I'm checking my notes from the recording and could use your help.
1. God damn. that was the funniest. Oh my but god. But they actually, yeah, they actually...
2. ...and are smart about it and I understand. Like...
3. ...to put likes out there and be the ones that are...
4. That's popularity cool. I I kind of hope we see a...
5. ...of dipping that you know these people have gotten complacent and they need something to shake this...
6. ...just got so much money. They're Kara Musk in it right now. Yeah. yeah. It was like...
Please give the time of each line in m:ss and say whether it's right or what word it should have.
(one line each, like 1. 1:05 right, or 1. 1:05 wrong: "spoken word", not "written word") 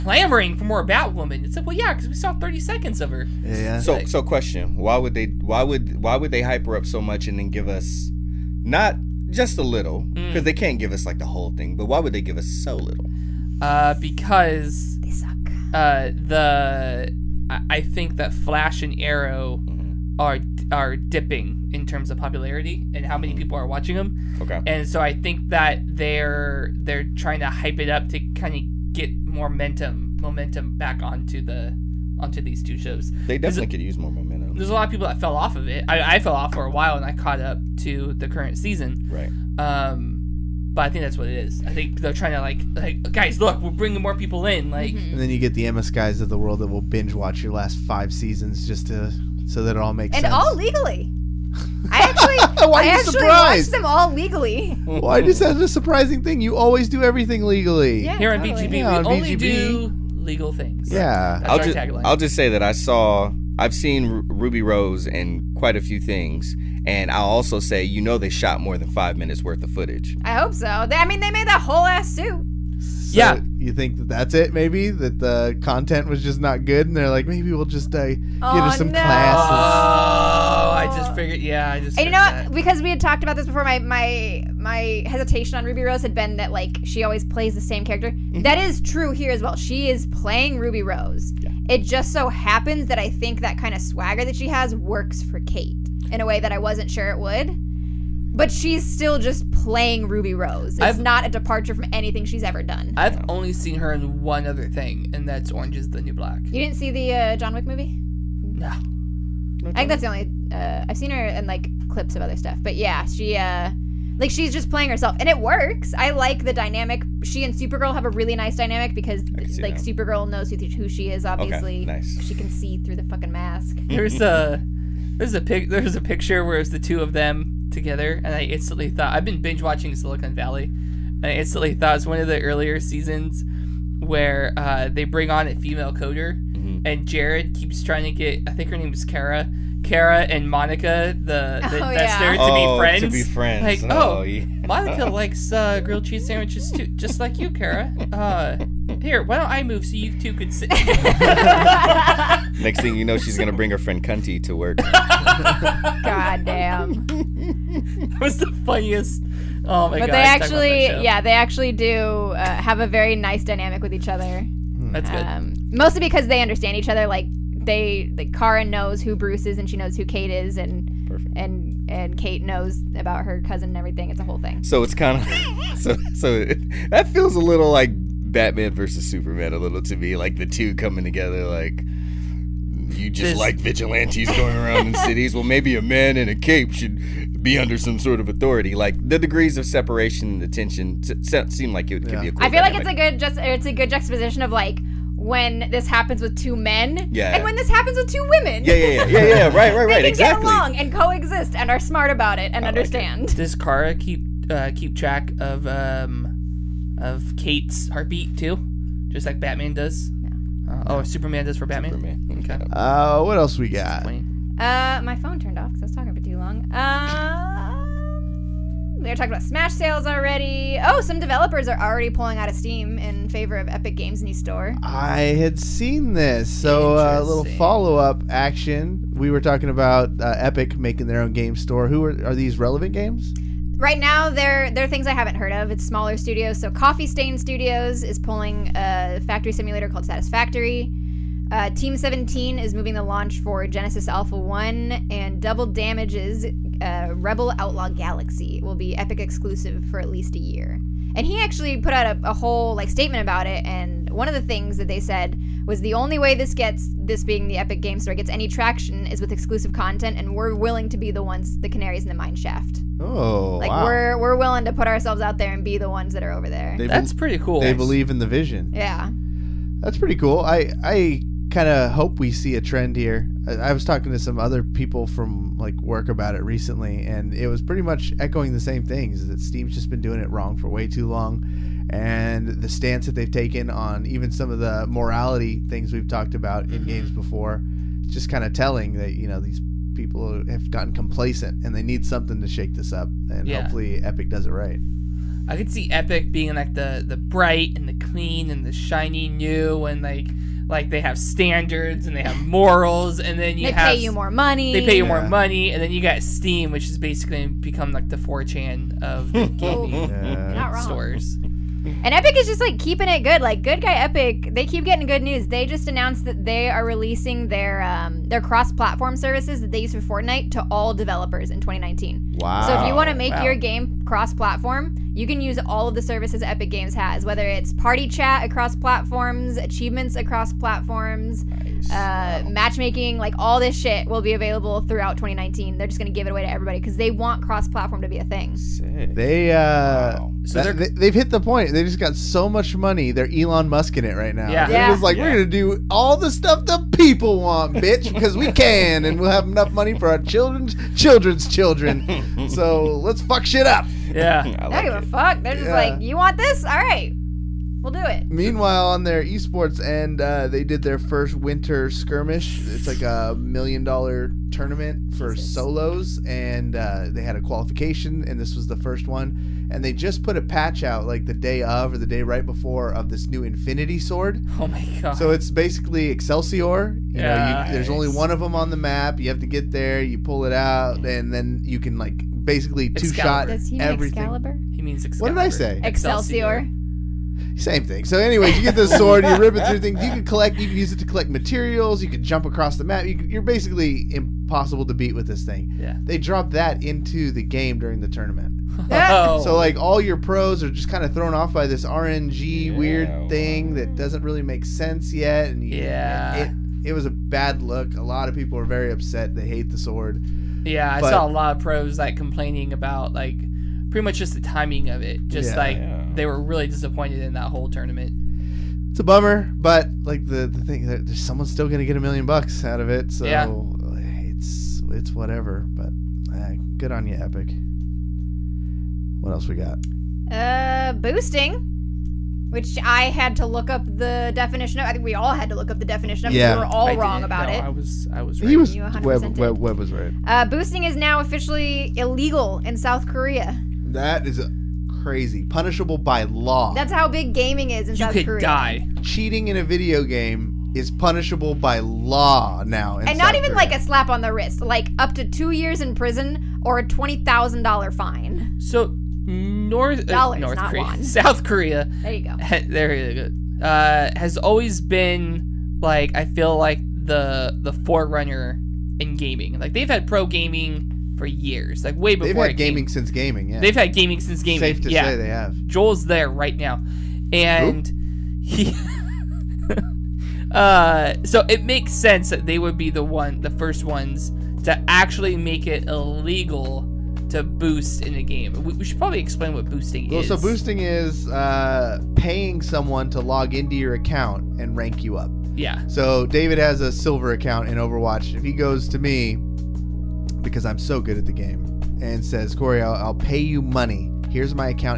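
1. 2:36 right
2. 3:21 right
3. 4:24 wrong: "ourselves", not "likes"
4. 4:29 wrong: "pretty", not "popularity"
5. 4:48 wrong: "telling", not "dipping"
6. 5:41 wrong: "Elon", not "Kara".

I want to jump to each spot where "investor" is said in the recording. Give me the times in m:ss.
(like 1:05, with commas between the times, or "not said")
2:21.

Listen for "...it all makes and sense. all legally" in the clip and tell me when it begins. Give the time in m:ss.
0:49.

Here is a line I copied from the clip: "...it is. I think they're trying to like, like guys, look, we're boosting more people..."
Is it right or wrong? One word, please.
wrong.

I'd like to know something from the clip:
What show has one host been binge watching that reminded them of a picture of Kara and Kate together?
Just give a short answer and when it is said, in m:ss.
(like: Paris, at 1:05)
Silicon Valley, at 2:09.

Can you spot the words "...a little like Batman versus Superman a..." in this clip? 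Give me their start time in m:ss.
2:57.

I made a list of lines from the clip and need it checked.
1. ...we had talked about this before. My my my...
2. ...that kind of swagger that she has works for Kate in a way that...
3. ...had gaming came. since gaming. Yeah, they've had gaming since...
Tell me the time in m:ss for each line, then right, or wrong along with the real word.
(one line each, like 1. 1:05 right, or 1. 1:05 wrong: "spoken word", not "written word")
1. 1:22 right
2. 1:33 right
3. 7:52 right.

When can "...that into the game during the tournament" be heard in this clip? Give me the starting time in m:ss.
6:36.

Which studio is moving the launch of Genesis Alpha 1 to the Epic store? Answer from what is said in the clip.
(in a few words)
Team 17.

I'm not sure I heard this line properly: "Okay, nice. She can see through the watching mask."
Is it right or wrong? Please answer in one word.
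wrong.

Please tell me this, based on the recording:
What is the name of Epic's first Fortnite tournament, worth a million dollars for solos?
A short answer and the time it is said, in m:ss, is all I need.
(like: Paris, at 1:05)
winter skirmish, at 6:01.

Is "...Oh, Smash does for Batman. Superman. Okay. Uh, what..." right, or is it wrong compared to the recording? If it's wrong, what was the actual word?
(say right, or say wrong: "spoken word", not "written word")
wrong: "Superman", not "Smash".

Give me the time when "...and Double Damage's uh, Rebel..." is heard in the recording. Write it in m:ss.
4:05.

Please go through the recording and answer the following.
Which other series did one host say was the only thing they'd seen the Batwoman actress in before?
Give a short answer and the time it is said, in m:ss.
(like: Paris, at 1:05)
Orange is the New Black, at 1:45.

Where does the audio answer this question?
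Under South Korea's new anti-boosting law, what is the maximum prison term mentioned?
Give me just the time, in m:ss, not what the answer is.
7:35.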